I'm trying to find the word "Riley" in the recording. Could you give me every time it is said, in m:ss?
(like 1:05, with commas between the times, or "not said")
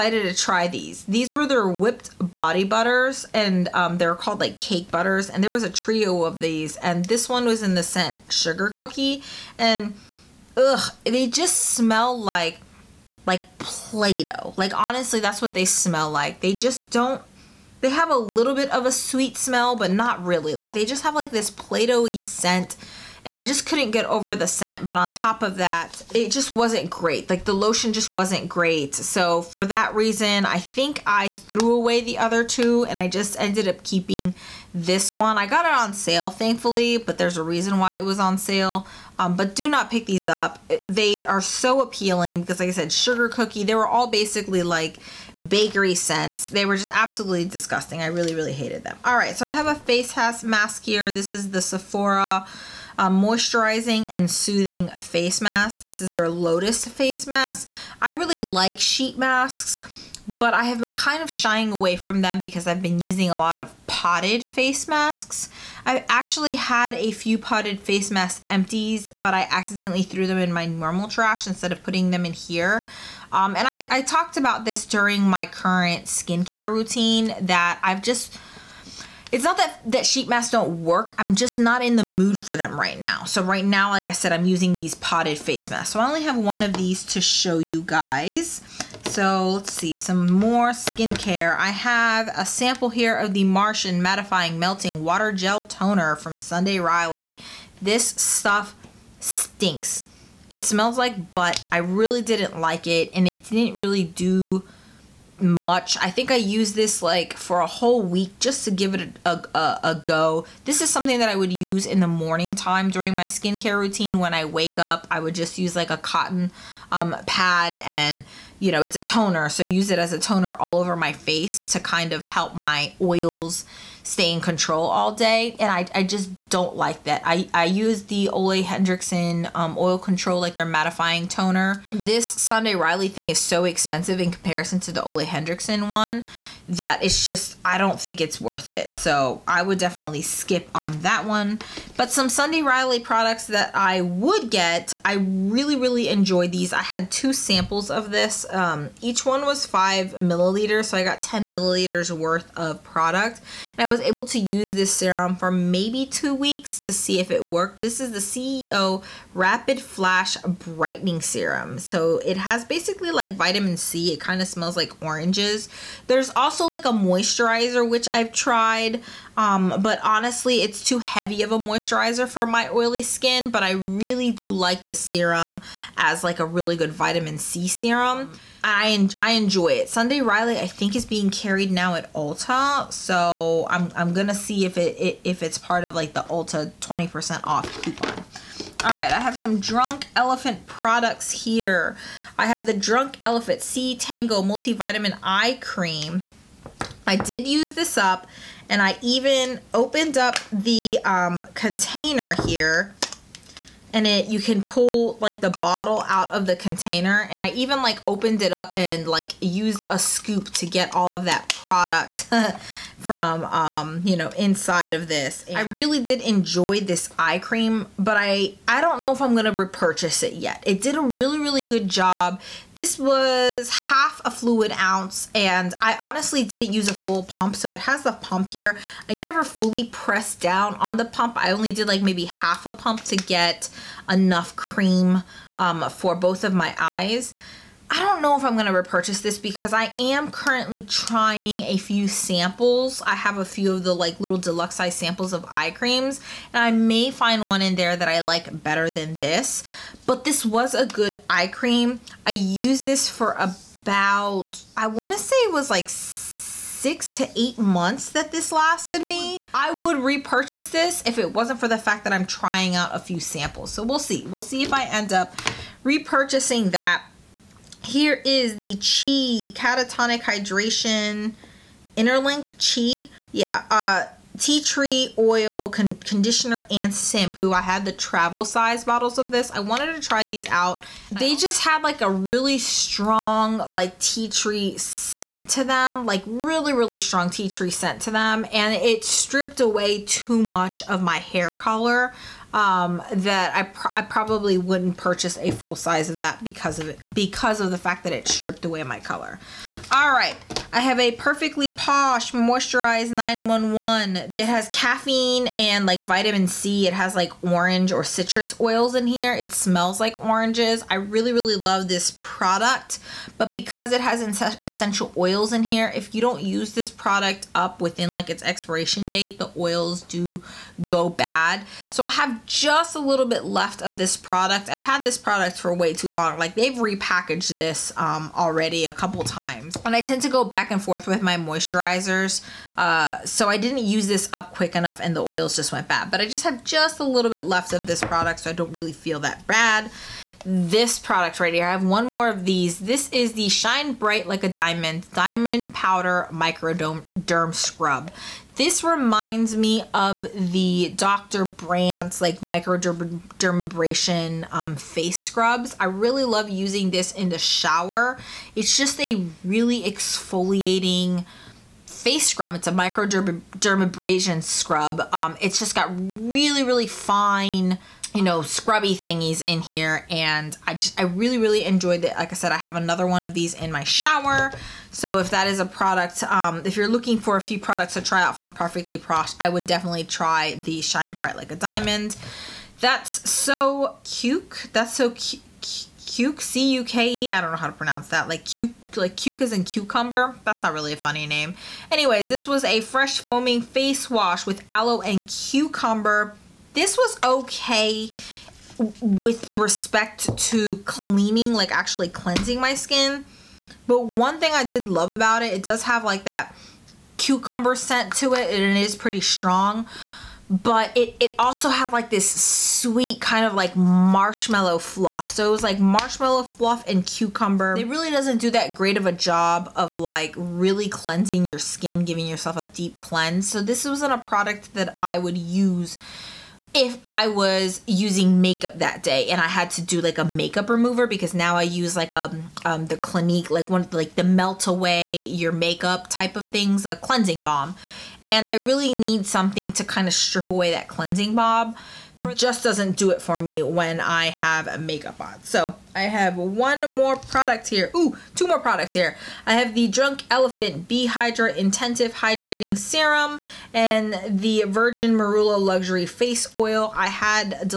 1:36, 2:12, 2:22, 3:00.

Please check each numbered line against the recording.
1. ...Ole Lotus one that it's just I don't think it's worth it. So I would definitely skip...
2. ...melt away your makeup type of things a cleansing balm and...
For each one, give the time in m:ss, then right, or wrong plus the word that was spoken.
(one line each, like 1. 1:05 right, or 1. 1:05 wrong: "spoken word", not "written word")
1. 2:15 wrong: "Henriksen", not "Lotus"
2. 7:14 right.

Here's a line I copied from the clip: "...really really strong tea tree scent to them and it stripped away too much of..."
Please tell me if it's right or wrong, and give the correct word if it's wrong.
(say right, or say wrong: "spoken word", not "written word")
right.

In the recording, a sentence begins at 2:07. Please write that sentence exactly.
I, I use the Ole Henriksen um, Oil Control, like their mattifying toner.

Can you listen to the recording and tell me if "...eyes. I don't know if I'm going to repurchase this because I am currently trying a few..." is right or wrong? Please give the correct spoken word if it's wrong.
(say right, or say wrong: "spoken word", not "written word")
right.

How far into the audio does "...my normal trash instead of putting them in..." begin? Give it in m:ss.
1:10.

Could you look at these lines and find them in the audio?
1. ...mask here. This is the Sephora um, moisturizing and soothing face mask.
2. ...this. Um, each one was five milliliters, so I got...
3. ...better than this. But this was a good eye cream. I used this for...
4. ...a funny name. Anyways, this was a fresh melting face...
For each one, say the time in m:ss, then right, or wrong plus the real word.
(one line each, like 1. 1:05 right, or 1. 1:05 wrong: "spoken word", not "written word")
1. 0:50 right
2. 2:28 right
3. 4:08 right
4. 6:30 wrong: "foaming", not "melting".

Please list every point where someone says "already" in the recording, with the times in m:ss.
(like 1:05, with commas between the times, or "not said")
5:28.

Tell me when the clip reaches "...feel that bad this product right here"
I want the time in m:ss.
5:38.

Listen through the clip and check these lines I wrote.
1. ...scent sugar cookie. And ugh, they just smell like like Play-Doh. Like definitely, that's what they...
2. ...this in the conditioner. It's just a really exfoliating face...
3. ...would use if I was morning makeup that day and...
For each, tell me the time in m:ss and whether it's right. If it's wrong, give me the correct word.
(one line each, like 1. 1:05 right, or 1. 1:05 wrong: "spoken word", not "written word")
1. 0:07 wrong: "honestly", not "definitely"
2. 5:56 wrong: "shower", not "conditioner"
3. 7:05 wrong: "using", not "morning".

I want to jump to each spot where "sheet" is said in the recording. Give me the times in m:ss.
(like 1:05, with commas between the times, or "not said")
0:58, 1:20.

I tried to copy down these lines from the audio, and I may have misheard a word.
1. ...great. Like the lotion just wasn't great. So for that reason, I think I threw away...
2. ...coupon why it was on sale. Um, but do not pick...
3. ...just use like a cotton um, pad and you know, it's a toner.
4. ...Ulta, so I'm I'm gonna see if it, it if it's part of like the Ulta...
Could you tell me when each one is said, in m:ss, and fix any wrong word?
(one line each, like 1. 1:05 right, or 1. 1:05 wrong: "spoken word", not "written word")
1. 0:26 right
2. 0:37 wrong: "reason", not "coupon"
3. 1:55 right
4. 3:02 right.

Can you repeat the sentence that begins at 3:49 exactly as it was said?
I never fully pressed down on the pump.